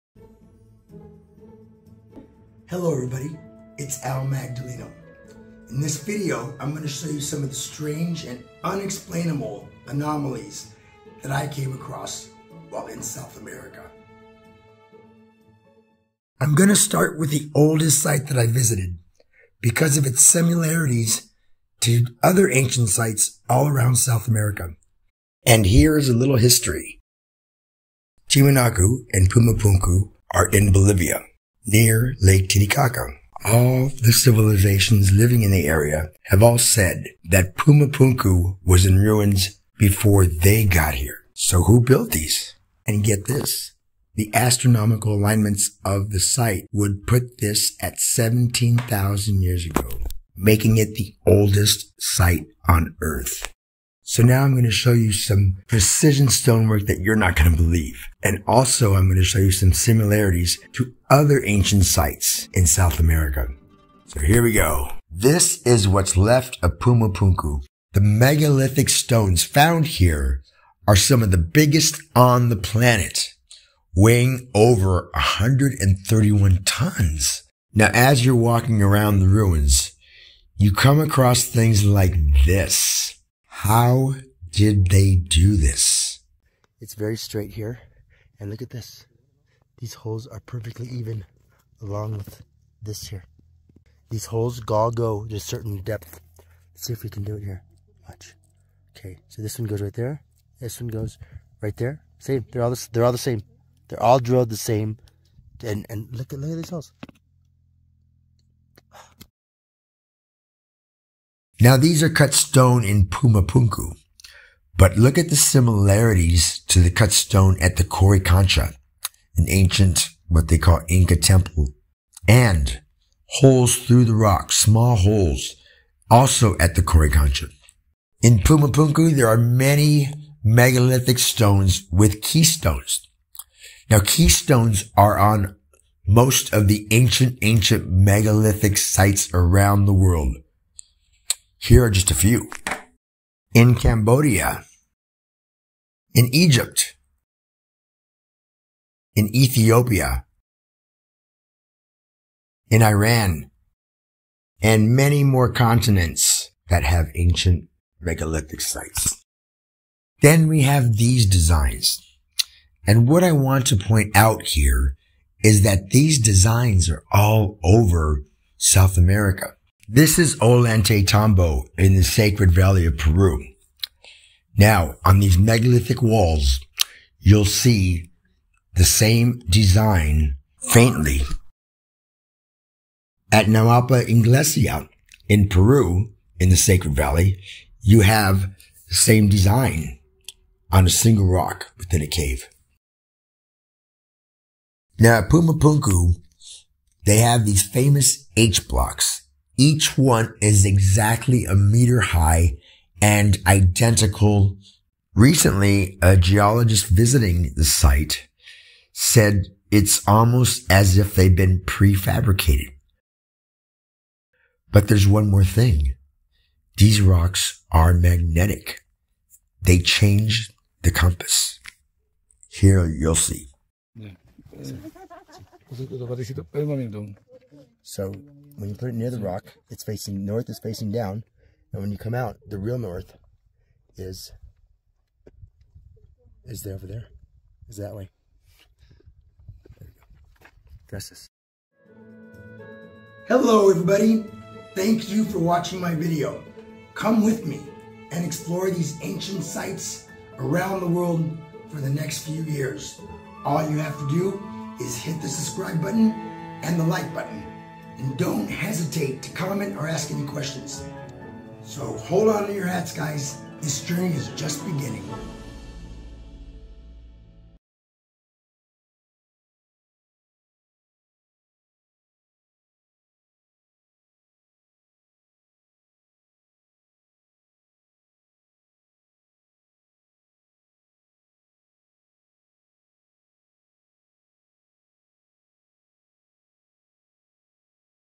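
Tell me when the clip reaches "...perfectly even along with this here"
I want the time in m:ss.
1:30.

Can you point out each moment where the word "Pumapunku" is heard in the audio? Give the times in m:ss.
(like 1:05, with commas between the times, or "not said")
0:29, 0:37, 1:06, 1:53, 2:08, 3:15.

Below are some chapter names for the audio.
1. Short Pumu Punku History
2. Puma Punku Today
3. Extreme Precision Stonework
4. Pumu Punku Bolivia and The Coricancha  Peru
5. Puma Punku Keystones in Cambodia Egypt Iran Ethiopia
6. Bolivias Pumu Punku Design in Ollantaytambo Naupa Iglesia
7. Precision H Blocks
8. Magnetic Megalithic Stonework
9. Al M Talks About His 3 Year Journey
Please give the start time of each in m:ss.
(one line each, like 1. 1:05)
1. 0:16
2. 0:53
3. 1:17
4. 1:50
5. 2:07
6. 2:39
7. 3:14
8. 3:33
9. 4:01.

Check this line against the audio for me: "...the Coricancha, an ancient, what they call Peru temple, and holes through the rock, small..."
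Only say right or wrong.
wrong.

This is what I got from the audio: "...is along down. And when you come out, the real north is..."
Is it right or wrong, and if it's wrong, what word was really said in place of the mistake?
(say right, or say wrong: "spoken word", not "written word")
wrong: "facing", not "along".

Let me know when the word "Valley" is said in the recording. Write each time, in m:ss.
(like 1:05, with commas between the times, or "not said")
2:52, 3:06.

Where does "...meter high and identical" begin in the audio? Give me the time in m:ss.
3:21.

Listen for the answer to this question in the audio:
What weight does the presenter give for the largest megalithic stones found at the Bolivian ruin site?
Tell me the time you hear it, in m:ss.
1:14.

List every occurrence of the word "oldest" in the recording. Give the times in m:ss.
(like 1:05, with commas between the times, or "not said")
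0:17, 0:51.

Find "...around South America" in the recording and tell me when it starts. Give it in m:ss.
0:23.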